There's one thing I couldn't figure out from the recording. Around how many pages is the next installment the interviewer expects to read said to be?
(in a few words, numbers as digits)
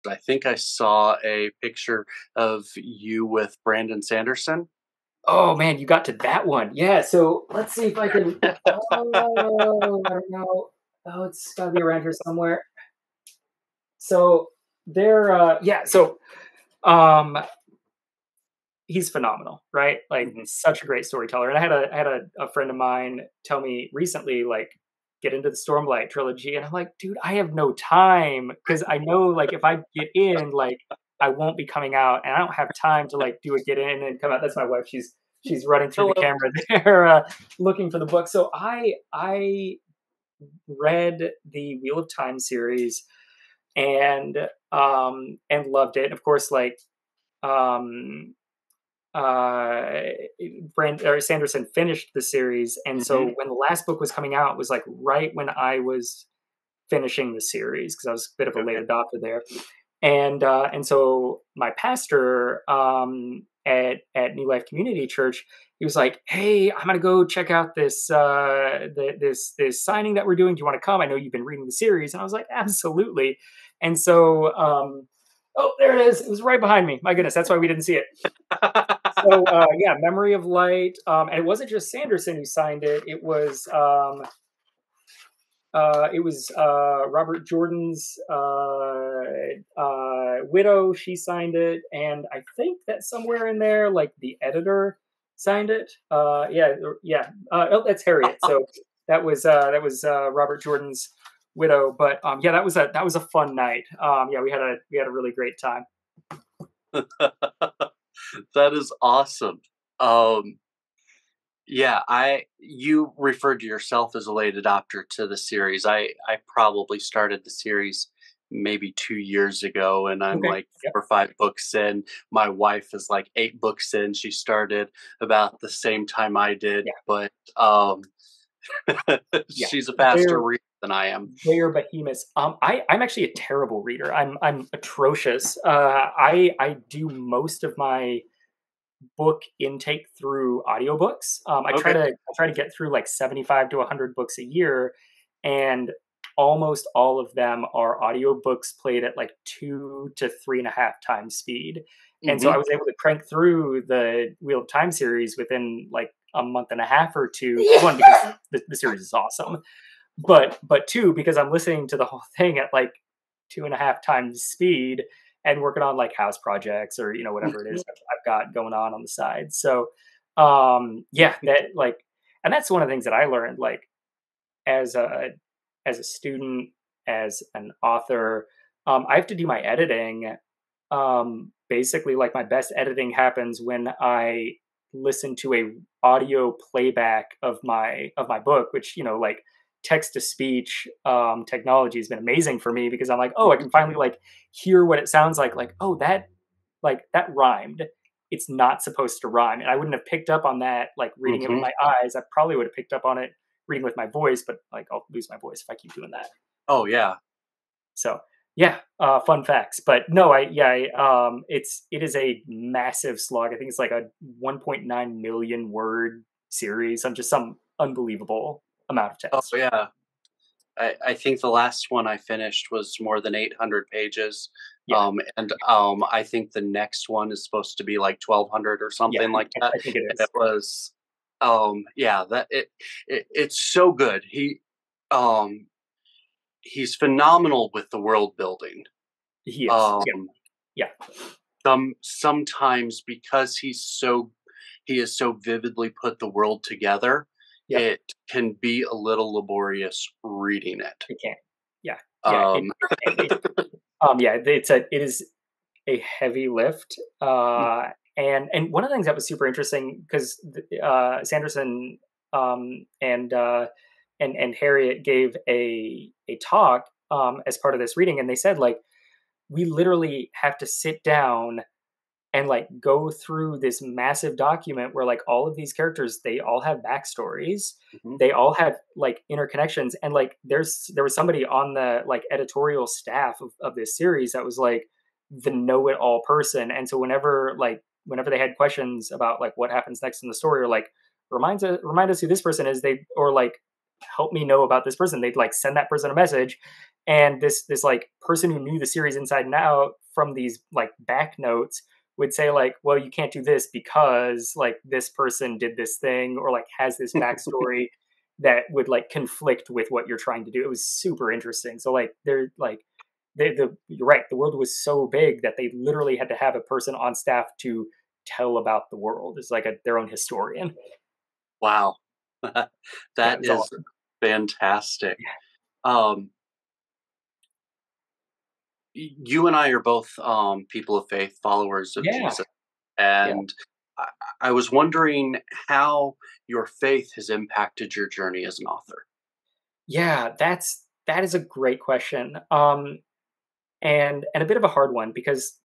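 1200.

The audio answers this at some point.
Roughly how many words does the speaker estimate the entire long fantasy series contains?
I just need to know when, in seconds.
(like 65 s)
214 s.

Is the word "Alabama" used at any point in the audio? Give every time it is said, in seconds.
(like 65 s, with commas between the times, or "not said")
not said.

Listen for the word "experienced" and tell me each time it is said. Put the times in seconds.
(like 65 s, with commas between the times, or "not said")
not said.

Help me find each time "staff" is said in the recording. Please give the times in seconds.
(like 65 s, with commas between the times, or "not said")
282 s, 317 s.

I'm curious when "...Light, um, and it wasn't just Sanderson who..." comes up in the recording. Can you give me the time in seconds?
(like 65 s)
80 s.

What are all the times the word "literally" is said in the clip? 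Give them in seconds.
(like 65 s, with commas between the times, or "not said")
269 s, 315 s.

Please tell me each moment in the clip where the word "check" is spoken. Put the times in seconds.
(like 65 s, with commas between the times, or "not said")
67 s.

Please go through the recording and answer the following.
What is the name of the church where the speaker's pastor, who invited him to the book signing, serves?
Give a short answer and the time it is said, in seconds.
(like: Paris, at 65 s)
New Life Community Church, at 64 s.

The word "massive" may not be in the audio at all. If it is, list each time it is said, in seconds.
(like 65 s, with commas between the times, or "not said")
212 s, 273 s.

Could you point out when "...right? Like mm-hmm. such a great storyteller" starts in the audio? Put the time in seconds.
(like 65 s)
19 s.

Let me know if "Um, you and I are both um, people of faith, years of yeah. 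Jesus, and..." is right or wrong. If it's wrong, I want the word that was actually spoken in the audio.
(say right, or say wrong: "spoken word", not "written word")
wrong: "followers", not "years".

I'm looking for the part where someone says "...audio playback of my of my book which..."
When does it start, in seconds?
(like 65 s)
186 s.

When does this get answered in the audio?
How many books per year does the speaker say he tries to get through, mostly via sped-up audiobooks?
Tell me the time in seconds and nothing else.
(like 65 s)
143 s.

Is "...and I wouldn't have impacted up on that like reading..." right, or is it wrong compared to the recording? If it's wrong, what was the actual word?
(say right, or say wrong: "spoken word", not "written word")
wrong: "picked", not "impacted".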